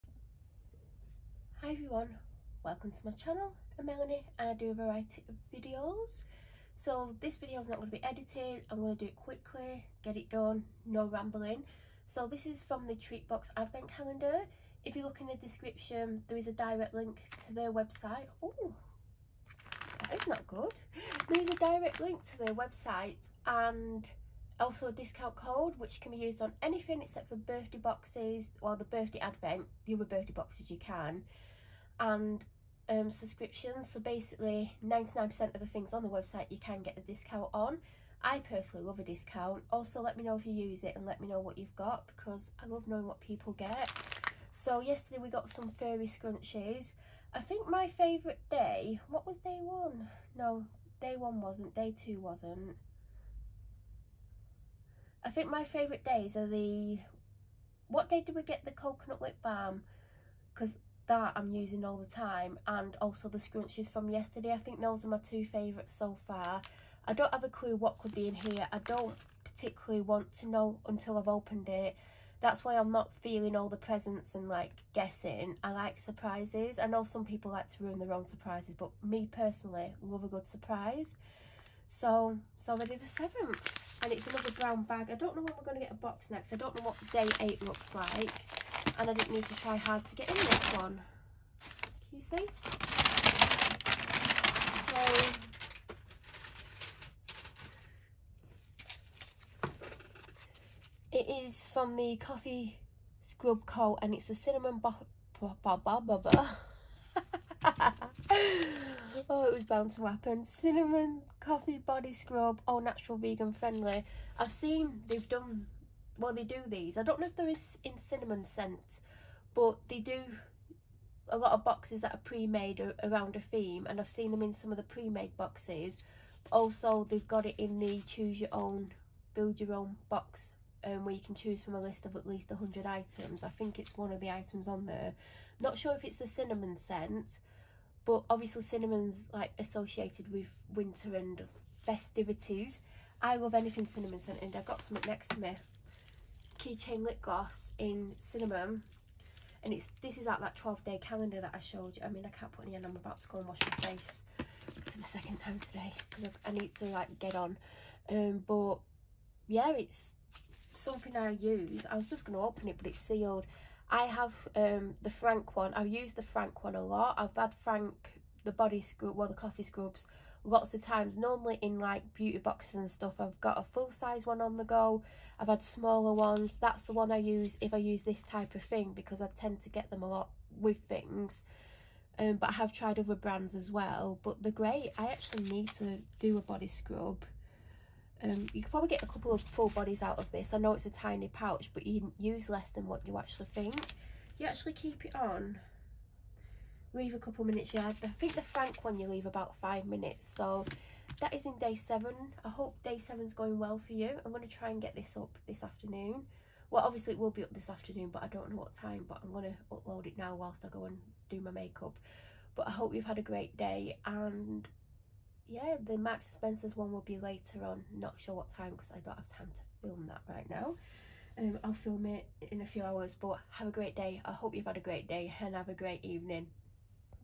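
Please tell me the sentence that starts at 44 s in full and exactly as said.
So yesterday we got some furry scrunchies.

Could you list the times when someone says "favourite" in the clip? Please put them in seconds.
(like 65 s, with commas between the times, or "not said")
47 s, 55 s, 65 s.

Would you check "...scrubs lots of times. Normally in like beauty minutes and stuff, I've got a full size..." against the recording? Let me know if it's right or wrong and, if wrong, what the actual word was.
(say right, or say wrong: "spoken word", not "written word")
wrong: "boxes", not "minutes".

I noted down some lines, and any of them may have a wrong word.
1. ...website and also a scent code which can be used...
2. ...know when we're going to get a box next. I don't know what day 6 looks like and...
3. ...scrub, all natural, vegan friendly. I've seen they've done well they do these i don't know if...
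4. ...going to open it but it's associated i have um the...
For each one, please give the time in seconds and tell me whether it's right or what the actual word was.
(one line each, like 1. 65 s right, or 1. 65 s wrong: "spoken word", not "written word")
1. 22 s wrong: "discount", not "scent"
2. 85 s wrong: "8", not "6"
3. 112 s right
4. 162 s wrong: "sealed", not "associated".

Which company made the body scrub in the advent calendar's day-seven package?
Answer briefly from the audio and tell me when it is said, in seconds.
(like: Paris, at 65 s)
Coffee Scrub Co, at 102 s.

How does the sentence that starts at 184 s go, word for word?
But the great, I actually need to do a body scrub.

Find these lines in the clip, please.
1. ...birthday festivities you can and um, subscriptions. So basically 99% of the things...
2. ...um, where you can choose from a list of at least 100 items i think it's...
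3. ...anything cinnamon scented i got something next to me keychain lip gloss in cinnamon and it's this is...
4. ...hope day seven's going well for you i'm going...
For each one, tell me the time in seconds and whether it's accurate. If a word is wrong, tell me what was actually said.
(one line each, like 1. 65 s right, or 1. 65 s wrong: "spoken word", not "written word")
1. 30 s wrong: "boxes", not "festivities"
2. 130 s right
3. 143 s right
4. 202 s right.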